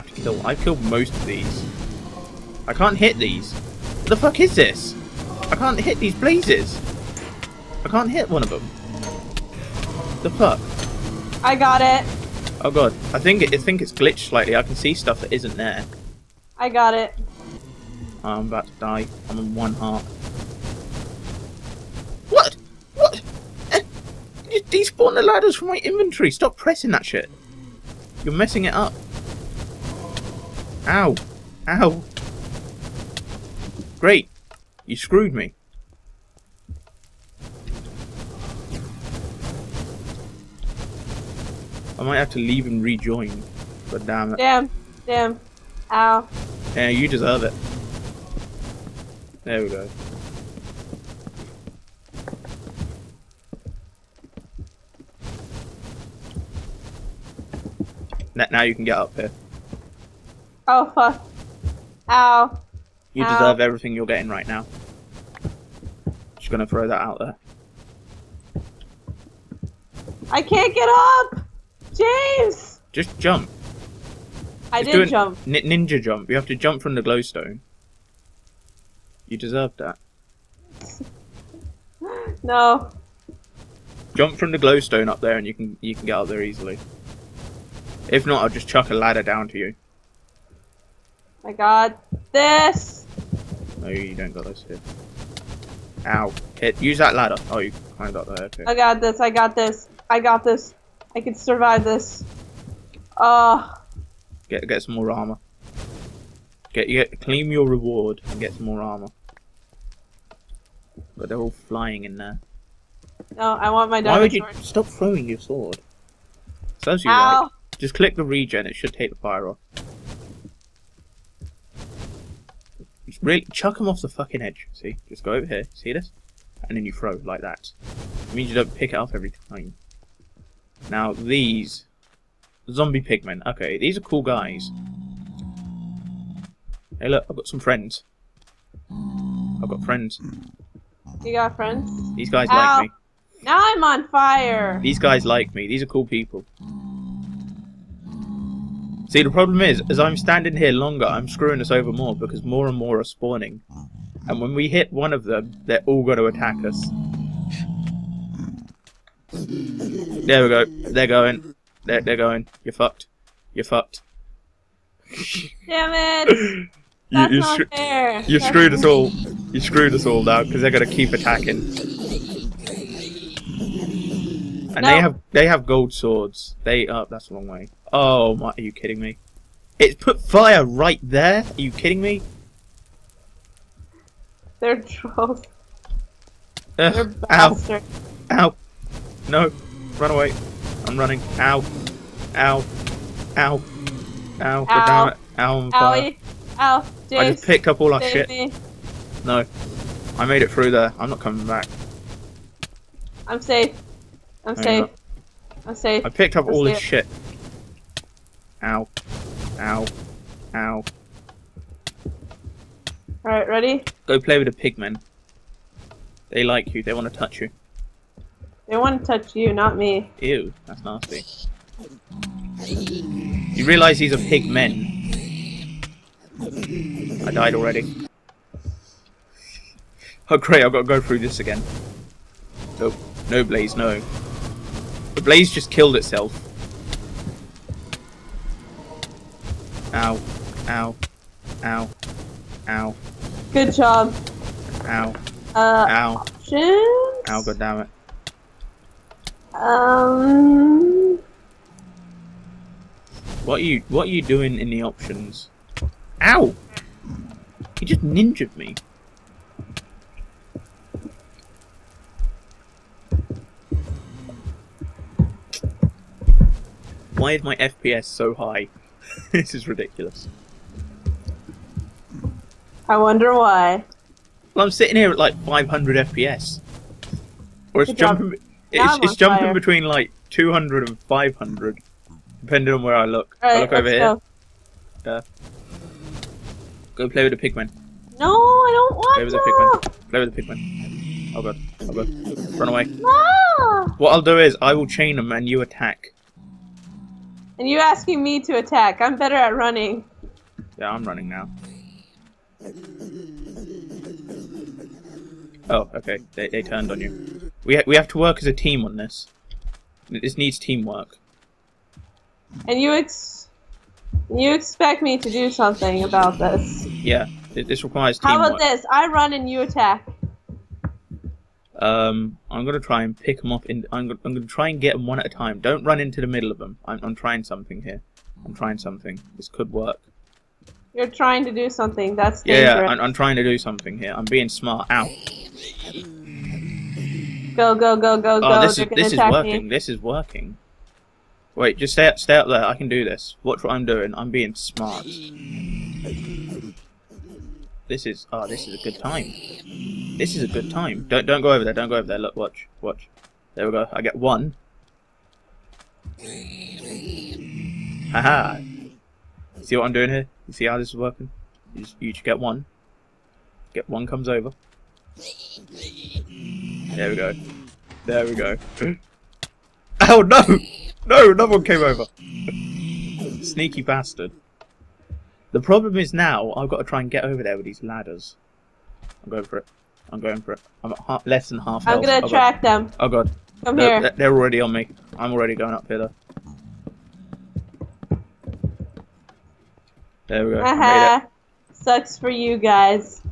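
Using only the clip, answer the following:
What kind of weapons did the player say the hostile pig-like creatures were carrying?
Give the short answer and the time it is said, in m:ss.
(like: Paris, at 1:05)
gold swords, at 2:55.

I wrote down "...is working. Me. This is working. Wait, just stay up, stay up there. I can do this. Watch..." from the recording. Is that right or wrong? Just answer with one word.
right.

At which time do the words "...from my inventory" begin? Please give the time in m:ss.
0:25.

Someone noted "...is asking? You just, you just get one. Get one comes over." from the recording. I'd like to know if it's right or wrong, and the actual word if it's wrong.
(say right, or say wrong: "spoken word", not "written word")
wrong: "working", not "asking".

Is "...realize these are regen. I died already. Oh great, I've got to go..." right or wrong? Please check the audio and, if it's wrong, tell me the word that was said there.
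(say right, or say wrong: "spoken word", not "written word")
wrong: "pigmen", not "regen".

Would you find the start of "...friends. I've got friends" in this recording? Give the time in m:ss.
2:17.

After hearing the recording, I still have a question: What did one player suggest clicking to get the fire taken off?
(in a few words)
the regen.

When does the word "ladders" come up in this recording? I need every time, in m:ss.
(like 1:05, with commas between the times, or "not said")
0:25, 1:28, 1:37, 6:17.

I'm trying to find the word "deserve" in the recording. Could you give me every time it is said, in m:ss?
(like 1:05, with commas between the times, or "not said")
0:47, 1:03, 1:19.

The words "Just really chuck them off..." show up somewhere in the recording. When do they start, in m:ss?
2:03.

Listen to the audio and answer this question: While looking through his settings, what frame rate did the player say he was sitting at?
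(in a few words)
500 FPS.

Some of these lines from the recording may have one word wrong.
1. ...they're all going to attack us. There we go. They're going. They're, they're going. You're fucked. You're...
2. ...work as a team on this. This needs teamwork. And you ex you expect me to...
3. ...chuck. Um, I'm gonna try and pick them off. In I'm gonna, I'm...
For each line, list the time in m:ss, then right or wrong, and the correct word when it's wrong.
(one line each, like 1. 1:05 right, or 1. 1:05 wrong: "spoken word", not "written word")
1. 2:35 right
2. 5:08 right
3. 5:19 wrong: "attack", not "chuck".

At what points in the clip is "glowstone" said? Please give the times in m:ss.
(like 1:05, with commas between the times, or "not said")
1:17, 1:24.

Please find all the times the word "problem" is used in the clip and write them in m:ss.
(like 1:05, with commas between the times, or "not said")
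2:29, 6:15.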